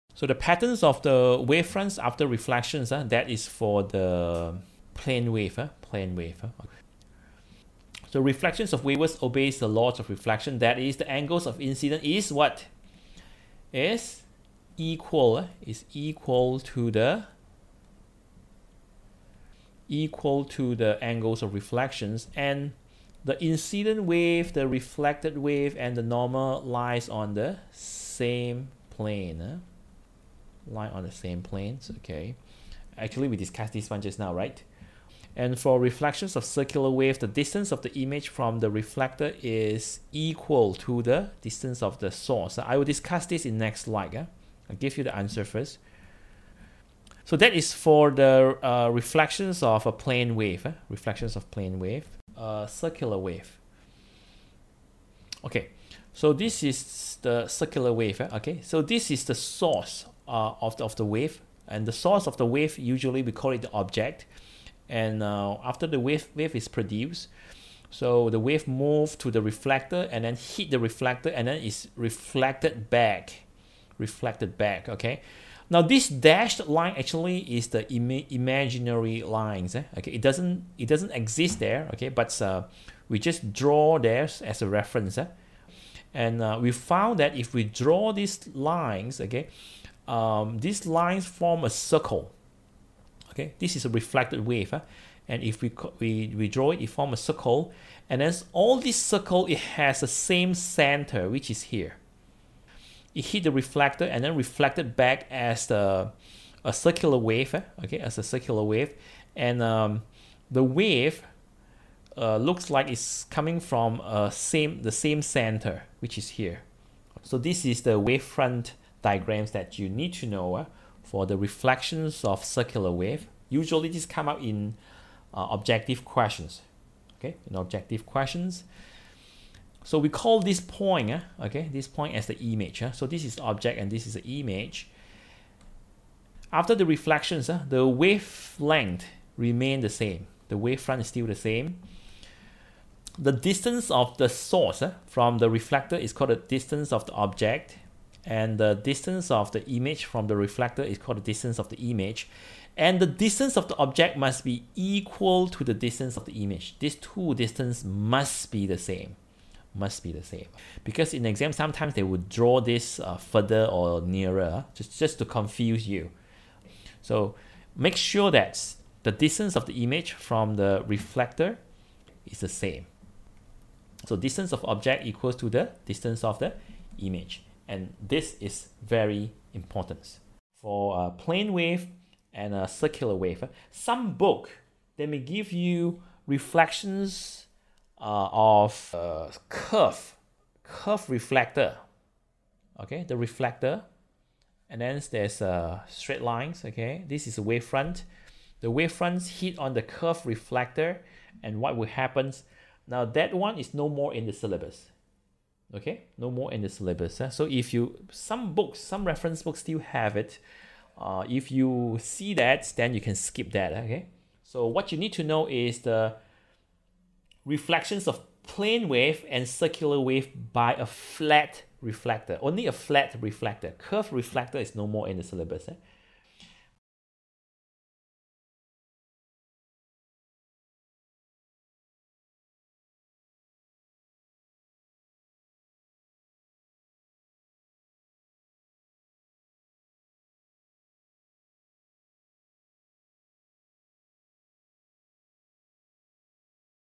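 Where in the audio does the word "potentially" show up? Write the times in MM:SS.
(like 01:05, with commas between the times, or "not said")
not said.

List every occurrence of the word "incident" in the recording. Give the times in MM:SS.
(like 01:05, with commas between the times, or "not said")
00:11, 00:23.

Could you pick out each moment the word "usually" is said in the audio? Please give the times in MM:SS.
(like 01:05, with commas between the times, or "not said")
01:02, 02:03.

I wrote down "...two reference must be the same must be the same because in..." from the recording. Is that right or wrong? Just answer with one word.
wrong.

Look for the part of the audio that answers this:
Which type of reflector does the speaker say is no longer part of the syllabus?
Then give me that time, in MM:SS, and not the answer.
03:43.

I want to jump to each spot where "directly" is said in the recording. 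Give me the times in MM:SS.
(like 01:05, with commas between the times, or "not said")
not said.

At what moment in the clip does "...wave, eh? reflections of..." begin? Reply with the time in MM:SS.
00:50.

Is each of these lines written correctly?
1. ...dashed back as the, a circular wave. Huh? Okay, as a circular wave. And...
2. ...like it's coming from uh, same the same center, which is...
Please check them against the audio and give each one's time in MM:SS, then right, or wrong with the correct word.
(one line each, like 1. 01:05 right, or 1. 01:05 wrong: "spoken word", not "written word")
1. 01:44 wrong: "reflected", not "dashed"
2. 01:52 right.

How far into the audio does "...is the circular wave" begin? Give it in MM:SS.
00:56.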